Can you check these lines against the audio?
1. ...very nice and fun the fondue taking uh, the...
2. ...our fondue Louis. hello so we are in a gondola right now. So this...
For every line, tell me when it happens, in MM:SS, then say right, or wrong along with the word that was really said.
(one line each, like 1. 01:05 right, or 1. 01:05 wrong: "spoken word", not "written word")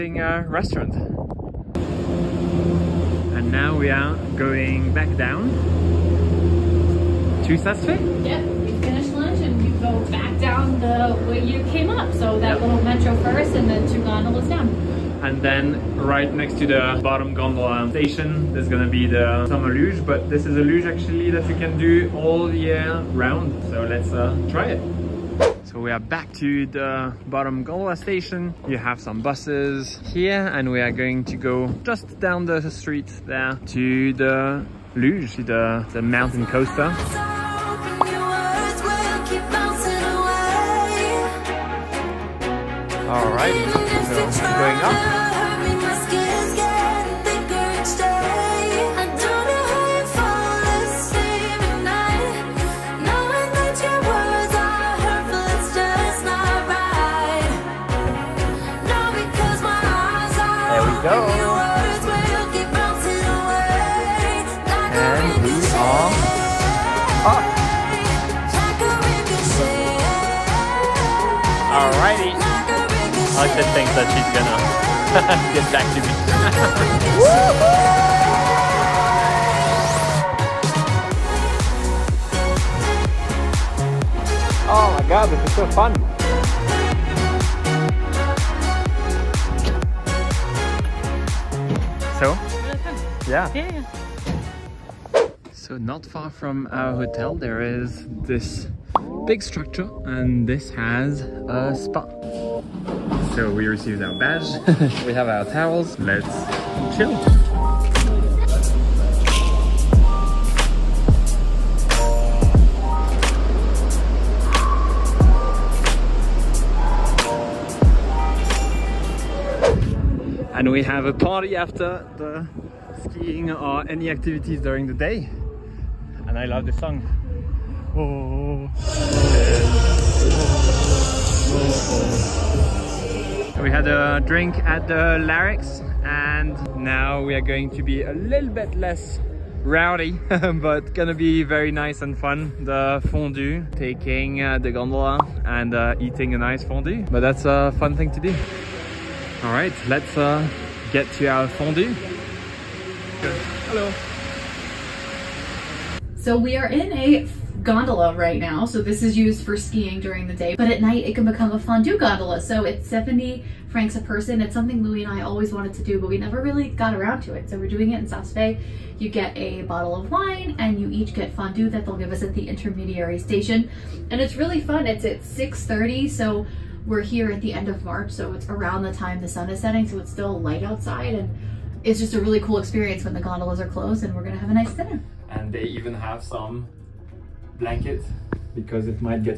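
1. 02:21 right
2. 02:31 wrong: "Good", not "Louis".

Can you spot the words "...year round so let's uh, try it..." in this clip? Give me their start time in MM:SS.
00:22.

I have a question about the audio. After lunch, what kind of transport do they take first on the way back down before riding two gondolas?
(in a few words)
little metro.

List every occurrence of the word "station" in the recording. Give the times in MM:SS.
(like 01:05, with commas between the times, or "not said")
00:17, 00:27, 02:53.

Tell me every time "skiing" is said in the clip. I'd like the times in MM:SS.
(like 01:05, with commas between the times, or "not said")
02:03, 02:39.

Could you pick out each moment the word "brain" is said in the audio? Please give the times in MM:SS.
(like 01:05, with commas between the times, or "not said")
not said.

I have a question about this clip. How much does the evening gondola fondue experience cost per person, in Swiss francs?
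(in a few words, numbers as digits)
70.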